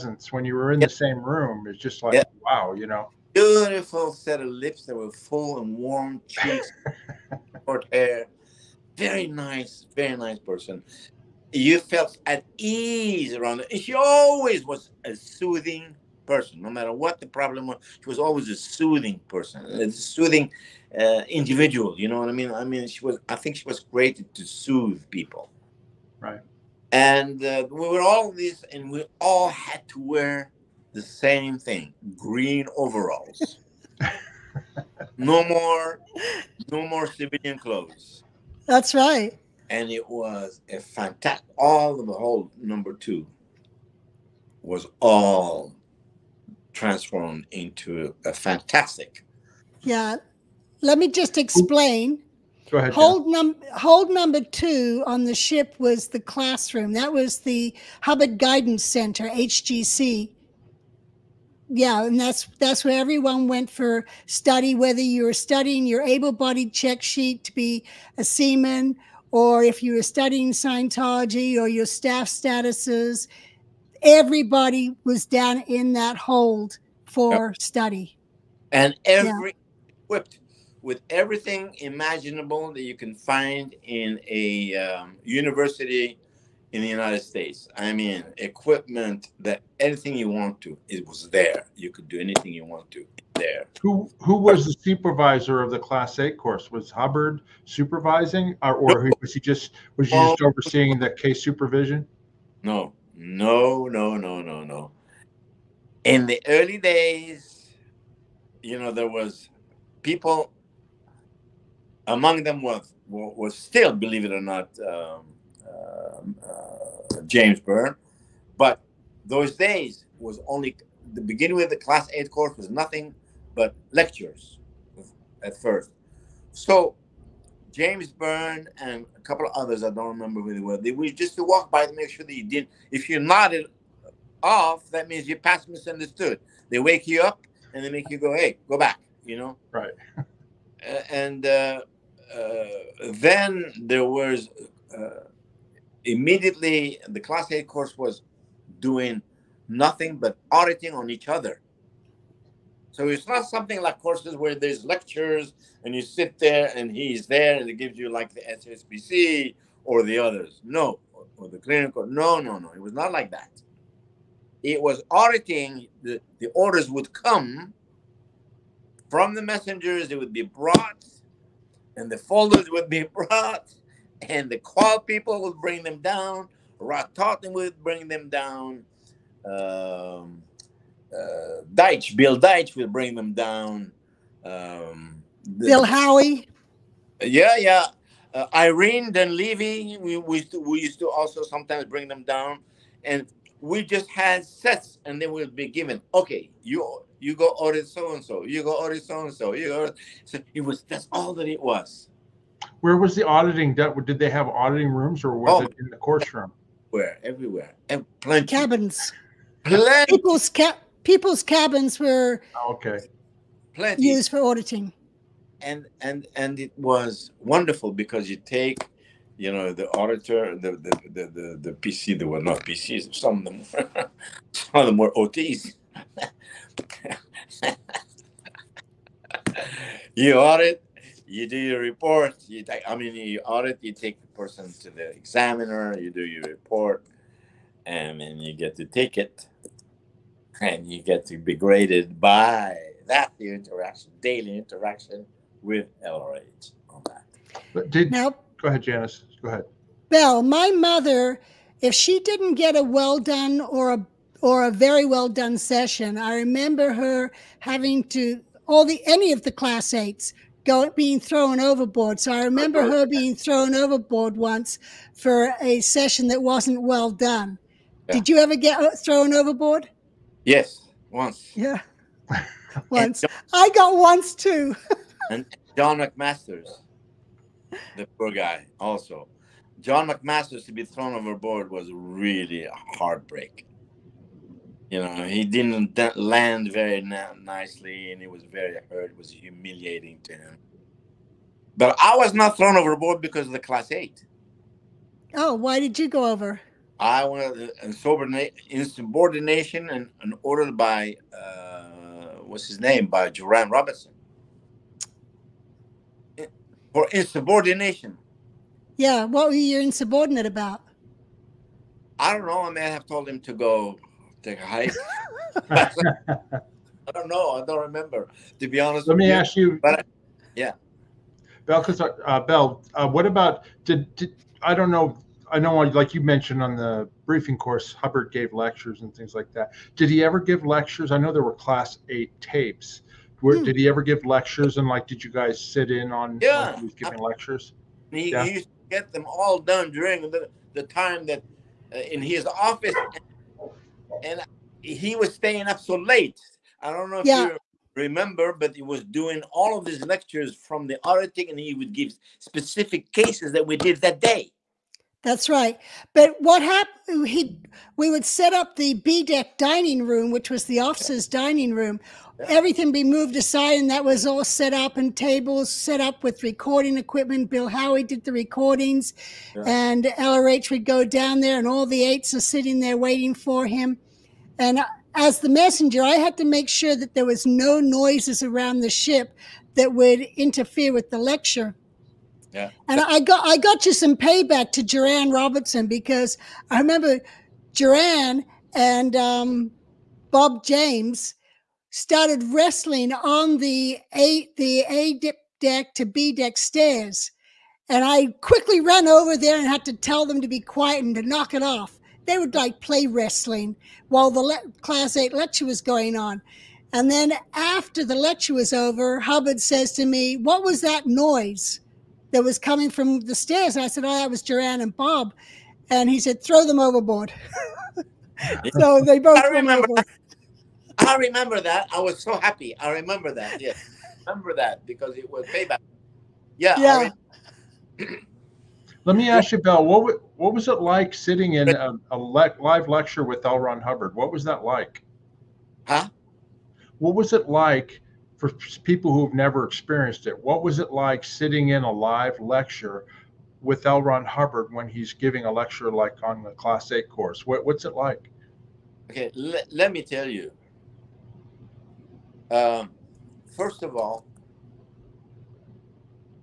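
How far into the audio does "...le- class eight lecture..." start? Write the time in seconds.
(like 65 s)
404 s.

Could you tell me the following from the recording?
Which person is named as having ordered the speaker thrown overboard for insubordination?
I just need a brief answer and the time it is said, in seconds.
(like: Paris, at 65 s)
Duran Robinson, at 303 s.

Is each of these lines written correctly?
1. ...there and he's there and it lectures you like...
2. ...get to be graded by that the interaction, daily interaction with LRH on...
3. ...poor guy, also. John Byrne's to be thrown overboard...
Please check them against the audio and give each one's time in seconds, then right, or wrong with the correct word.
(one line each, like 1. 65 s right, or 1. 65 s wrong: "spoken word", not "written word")
1. 156 s wrong: "gives", not "lectures"
2. 241 s right
3. 278 s wrong: "McMaster", not "Byrne".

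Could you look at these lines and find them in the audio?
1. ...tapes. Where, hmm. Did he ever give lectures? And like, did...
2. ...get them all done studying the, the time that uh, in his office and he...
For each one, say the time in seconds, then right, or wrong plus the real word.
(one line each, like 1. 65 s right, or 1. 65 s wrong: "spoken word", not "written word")
1. 332 s right
2. 338 s wrong: "during", not "studying".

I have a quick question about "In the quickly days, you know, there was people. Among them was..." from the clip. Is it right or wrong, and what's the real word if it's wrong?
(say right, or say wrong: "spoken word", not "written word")
wrong: "early", not "quickly".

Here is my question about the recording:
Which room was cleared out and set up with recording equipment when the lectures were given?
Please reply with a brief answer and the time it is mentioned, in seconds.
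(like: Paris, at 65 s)
B deck dining room, at 358 s.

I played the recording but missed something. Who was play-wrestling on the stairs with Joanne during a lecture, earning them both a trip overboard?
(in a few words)
Bob James.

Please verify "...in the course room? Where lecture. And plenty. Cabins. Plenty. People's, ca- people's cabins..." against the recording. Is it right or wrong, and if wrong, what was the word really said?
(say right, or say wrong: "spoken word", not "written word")
wrong: "everywhere", not "lecture".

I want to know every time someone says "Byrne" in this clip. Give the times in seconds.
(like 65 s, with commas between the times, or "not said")
117 s, 128 s.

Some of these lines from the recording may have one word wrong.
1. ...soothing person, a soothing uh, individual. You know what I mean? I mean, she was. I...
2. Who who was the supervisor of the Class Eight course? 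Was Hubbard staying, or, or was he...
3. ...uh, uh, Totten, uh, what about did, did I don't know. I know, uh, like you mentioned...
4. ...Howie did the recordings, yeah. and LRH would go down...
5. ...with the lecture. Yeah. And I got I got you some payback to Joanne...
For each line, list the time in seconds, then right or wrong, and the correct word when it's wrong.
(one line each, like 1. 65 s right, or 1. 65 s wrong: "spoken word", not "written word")
1. 18 s right
2. 93 s wrong: "supervising", not "staying"
3. 322 s wrong: "Bell", not "Totten"
4. 367 s right
5. 380 s right.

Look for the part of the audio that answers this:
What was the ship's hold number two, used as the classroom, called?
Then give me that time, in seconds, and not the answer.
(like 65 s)
58 s.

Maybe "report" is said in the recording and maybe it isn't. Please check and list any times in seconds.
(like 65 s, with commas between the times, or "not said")
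231 s, 236 s.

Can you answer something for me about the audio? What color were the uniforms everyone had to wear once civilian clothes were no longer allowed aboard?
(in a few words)
green overalls.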